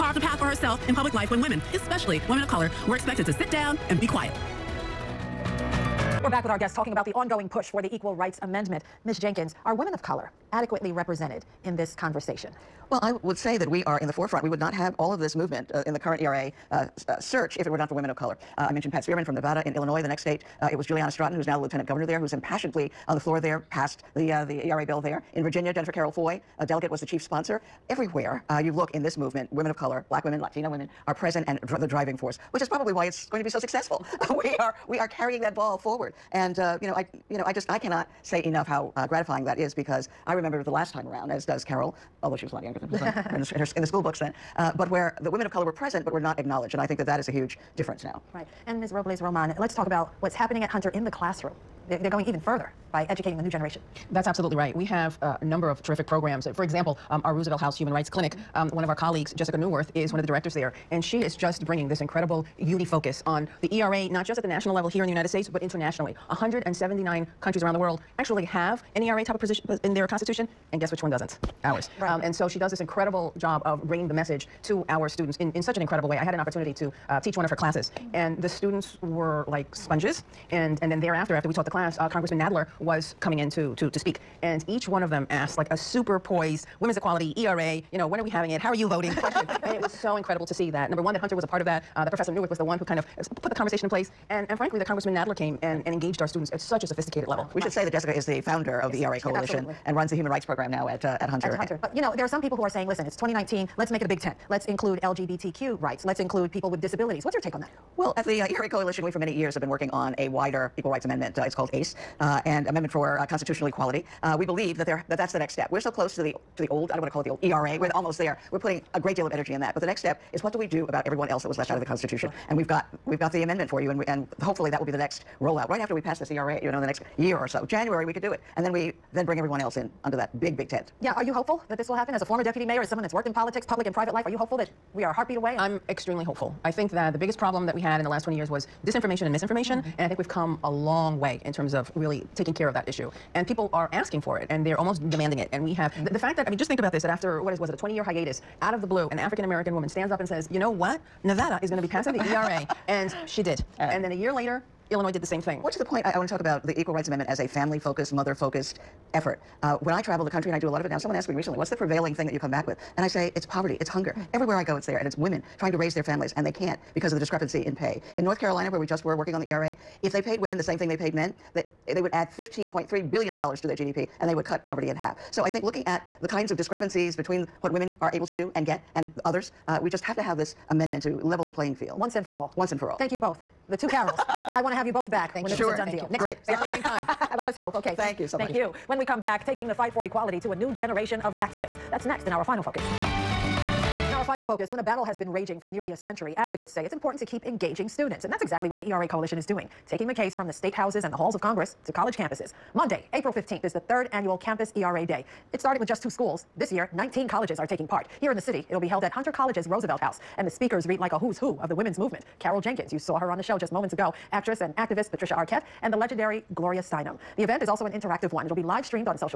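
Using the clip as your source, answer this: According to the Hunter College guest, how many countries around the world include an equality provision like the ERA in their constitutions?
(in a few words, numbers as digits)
179.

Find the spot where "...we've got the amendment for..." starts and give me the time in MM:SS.
02:03.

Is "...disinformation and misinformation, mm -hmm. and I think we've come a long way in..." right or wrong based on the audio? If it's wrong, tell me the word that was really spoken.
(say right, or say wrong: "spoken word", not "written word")
right.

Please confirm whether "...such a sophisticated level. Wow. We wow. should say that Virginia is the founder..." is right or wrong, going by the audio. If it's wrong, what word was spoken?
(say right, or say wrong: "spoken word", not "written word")
wrong: "Jessica", not "Virginia".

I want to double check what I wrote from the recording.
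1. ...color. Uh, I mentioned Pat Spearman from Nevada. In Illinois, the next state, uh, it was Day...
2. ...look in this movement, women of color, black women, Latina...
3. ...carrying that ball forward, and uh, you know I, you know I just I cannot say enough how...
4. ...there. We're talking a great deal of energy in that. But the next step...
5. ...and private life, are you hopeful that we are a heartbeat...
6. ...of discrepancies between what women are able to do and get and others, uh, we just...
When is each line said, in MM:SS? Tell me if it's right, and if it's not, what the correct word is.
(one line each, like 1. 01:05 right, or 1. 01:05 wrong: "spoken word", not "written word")
1. 00:18 wrong: "Juliana", not "Day"
2. 00:28 right
3. 00:35 right
4. 01:58 wrong: "putting", not "talking"
5. 02:13 right
6. 02:56 right.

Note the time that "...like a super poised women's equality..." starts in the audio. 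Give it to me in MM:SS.
01:25.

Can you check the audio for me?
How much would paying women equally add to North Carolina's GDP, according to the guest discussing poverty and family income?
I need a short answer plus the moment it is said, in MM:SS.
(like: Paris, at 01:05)
$15.3 billion, at 02:52.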